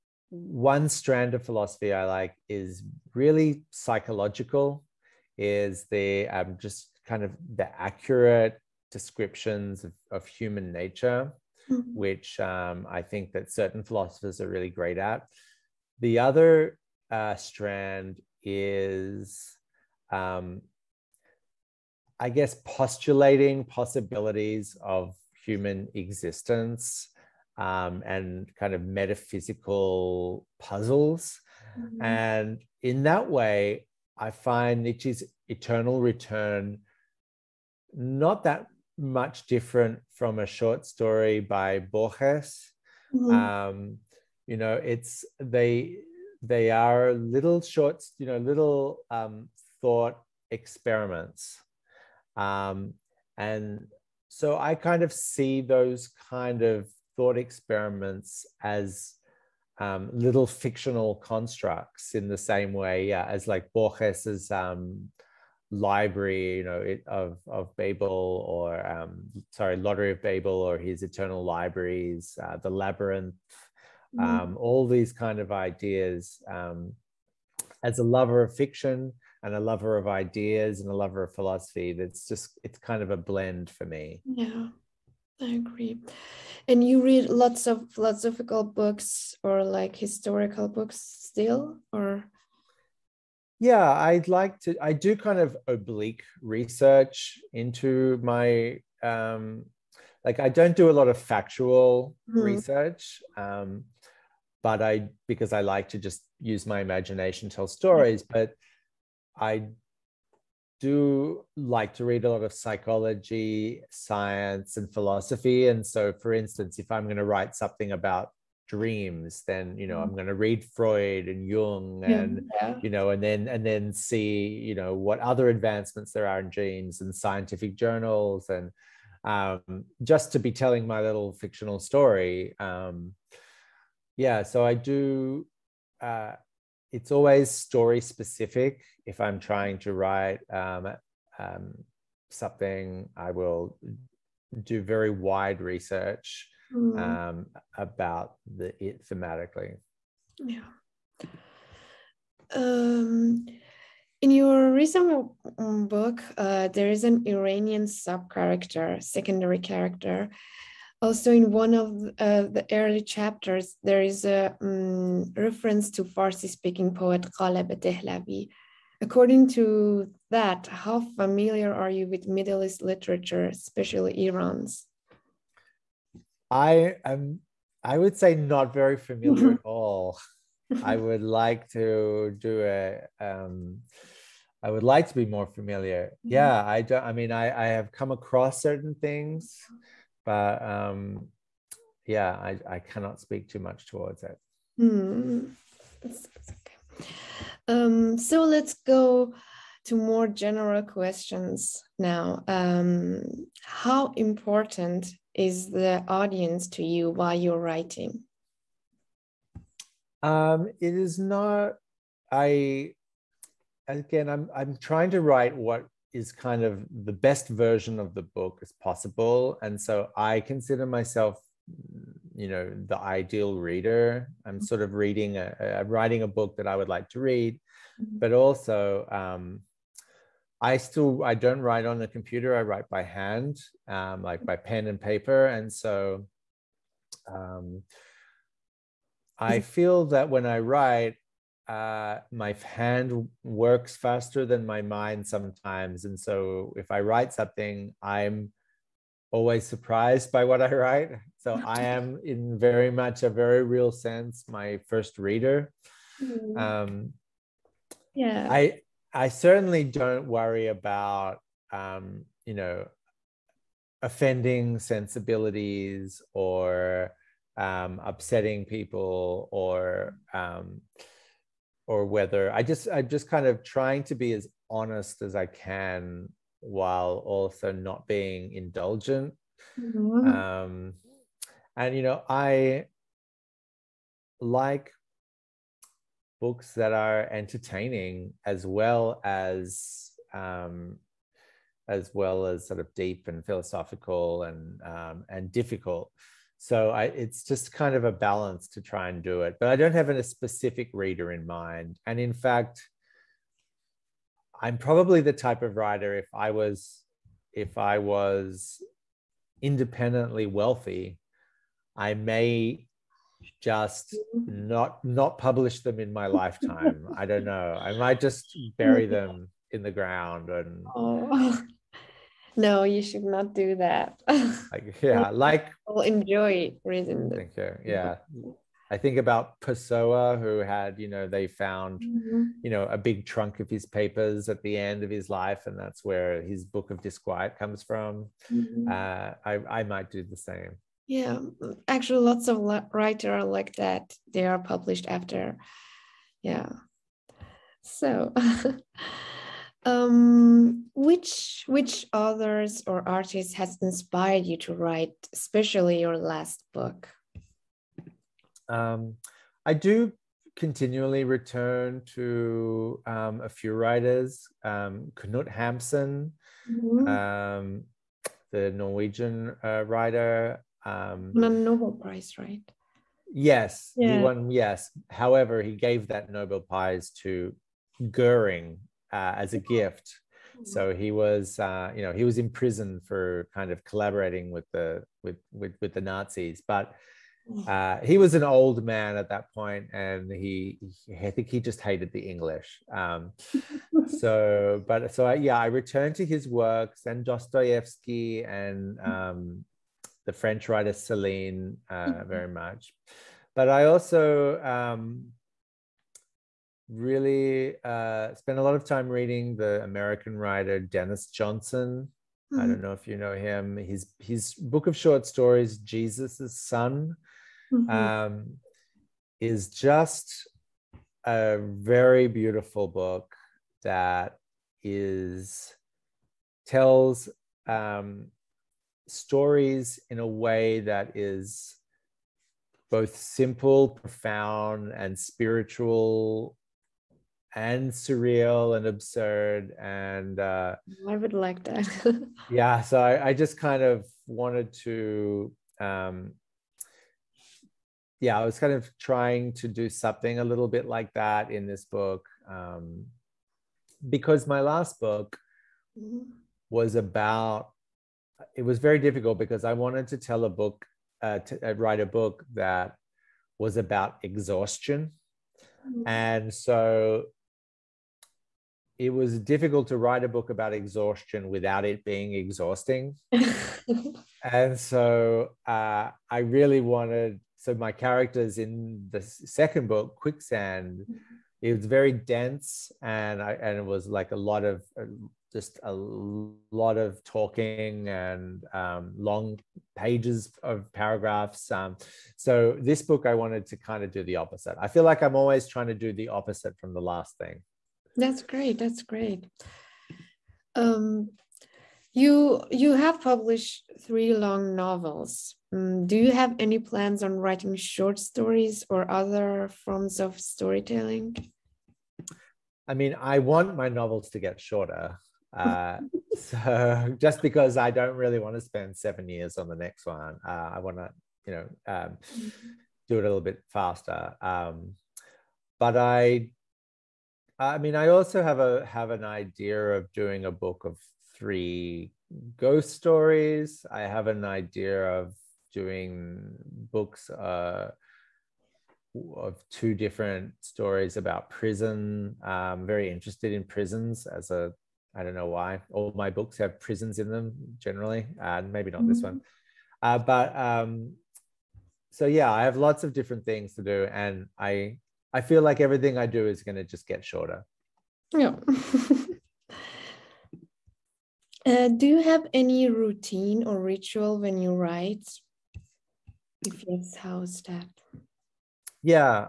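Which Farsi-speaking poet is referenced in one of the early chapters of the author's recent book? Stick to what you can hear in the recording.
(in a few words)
Ghalib Dehlavi.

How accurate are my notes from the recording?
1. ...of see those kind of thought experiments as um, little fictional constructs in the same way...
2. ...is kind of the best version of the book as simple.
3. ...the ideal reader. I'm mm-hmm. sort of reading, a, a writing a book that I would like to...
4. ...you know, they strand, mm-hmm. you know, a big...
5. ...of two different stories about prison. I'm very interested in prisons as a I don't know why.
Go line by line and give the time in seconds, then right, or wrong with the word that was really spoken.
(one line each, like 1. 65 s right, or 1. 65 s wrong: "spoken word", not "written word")
1. 55 s right
2. 216 s wrong: "possible", not "simple"
3. 222 s right
4. 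330 s wrong: "found", not "strand"
5. 539 s right.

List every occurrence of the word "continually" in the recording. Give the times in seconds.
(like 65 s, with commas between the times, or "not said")
360 s.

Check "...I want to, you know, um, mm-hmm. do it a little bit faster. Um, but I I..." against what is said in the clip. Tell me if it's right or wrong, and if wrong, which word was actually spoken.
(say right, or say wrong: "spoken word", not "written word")
right.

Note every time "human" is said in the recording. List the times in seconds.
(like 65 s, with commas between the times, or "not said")
10 s, 25 s.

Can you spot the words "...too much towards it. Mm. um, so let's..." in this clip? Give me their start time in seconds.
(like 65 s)
193 s.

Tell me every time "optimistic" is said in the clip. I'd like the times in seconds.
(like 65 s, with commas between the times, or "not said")
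not said.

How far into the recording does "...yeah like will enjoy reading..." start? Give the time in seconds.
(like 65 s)
325 s.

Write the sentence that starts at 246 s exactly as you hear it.
And so if I write something, I'm always surprised by what I write.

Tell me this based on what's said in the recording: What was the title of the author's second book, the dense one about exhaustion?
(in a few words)
Quicksand.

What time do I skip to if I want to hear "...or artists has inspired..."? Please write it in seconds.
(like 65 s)
352 s.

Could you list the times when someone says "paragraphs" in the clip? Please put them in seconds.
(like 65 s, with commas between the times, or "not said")
490 s.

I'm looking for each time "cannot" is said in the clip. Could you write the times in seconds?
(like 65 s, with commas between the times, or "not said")
192 s.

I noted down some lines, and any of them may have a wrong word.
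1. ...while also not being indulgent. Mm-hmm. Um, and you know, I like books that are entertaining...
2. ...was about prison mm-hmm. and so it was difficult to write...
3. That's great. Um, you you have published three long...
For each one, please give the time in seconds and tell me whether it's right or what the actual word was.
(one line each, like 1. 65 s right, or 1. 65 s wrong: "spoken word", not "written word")
1. 276 s right
2. 463 s wrong: "exhaustion", not "prison"
3. 498 s right.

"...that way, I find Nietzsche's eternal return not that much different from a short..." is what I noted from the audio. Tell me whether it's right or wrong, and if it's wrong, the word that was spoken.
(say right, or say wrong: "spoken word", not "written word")
right.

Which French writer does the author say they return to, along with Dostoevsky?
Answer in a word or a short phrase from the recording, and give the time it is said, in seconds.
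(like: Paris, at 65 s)
Celine, at 400 s.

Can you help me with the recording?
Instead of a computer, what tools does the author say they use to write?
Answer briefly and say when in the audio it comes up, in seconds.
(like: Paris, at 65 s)
pen and paper, at 234 s.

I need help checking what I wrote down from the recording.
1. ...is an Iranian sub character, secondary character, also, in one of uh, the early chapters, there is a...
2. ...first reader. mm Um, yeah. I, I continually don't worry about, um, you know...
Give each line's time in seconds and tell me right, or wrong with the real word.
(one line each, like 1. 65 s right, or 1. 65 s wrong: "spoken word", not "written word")
1. 156 s right
2. 254 s wrong: "certainly", not "continually".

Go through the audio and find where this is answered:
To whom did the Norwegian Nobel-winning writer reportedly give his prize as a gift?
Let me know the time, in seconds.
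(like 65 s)
378 s.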